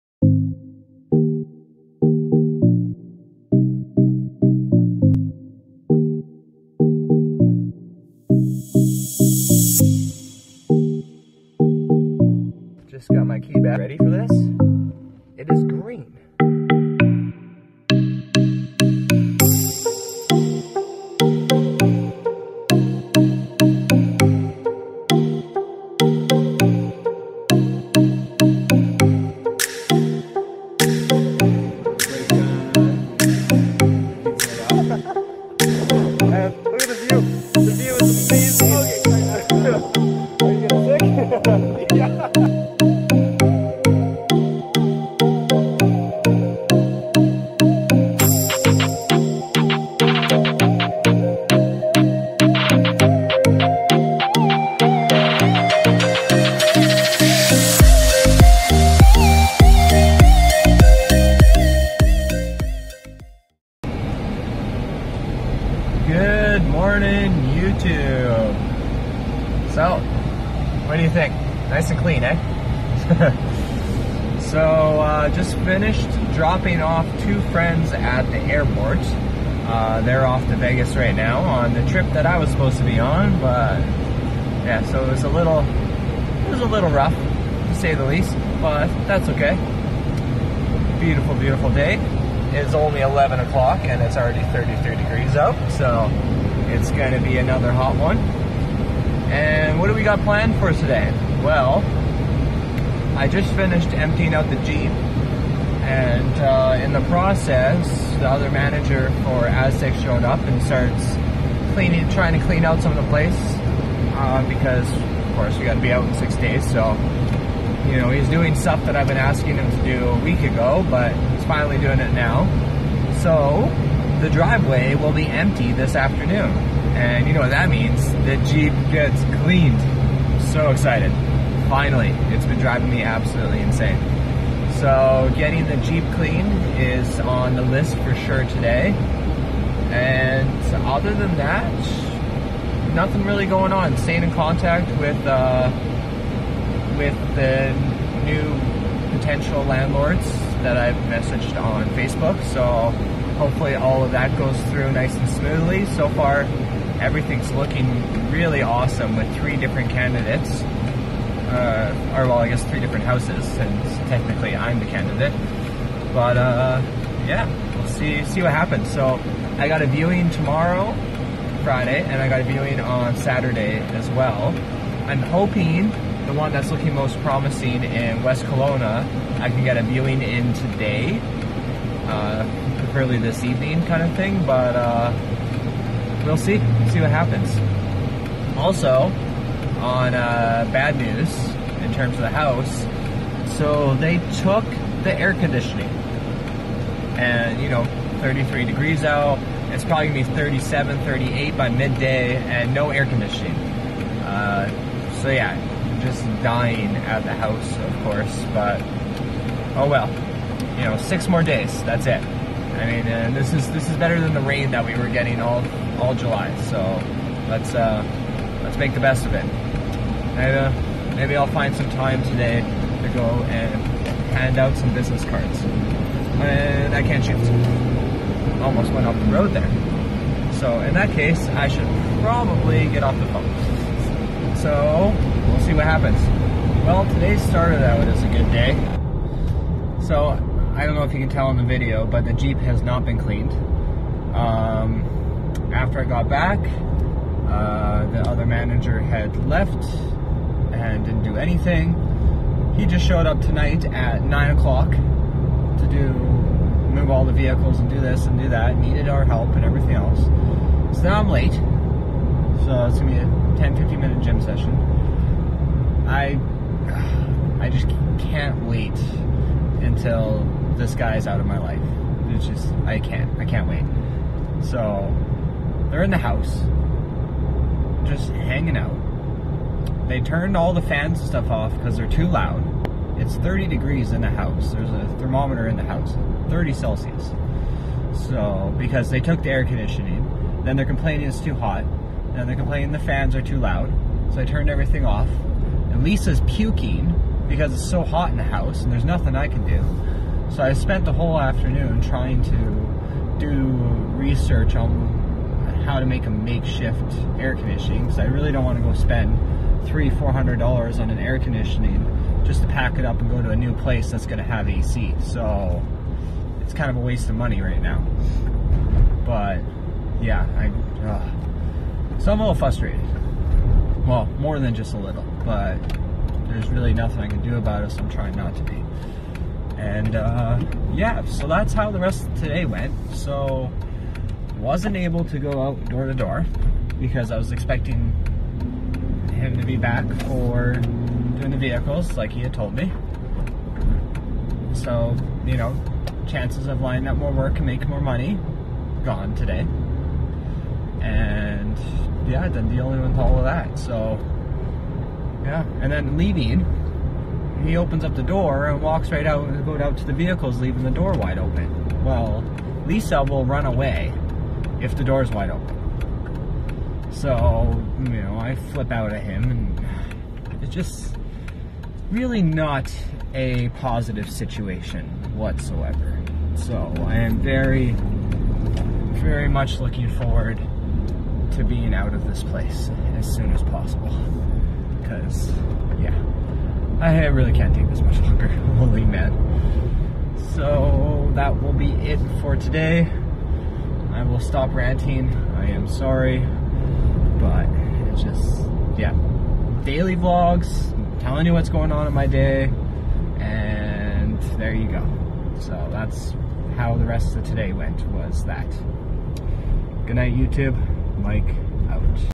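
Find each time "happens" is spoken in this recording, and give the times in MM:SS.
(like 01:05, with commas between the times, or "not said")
02:48, 03:07, 03:55.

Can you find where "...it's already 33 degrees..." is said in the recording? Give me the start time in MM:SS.
01:34.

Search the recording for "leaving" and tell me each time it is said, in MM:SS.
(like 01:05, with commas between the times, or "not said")
05:56, 06:00.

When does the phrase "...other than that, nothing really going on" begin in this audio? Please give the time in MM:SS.
02:20.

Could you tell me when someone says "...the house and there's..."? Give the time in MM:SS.
04:58.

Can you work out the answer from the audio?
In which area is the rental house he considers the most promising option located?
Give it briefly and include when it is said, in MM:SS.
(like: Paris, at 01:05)
West Kelowna, at 02:58.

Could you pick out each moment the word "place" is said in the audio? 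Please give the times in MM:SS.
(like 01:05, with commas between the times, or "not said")
01:53, 05:13, 06:22.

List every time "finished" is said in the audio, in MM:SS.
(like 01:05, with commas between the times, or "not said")
01:15, 01:43.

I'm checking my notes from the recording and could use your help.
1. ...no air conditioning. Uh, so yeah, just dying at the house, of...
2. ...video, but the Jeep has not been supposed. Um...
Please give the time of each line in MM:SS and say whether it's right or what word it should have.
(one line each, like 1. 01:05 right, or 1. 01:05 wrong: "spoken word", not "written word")
1. 03:22 right
2. 04:01 wrong: "cleaned", not "supposed".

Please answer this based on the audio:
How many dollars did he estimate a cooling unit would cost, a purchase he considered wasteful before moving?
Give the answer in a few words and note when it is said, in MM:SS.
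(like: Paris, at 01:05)
$300-400, at 05:09.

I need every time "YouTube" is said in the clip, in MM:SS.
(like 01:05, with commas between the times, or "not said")
01:07, 06:50.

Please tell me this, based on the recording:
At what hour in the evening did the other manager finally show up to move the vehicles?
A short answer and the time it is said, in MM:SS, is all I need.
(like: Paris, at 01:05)
9 o'clock, at 04:14.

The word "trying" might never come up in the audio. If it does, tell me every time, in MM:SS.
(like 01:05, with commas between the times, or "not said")
01:52, 05:02, 05:28.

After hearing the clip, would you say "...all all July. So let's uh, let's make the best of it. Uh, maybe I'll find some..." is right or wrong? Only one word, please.
right.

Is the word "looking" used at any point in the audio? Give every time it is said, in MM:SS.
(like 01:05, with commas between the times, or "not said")
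02:37, 02:56, 06:19.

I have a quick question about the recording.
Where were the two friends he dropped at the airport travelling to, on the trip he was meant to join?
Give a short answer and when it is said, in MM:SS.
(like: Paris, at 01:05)
Vegas, at 01:20.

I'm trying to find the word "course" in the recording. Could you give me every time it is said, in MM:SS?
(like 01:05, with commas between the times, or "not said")
01:55, 03:28.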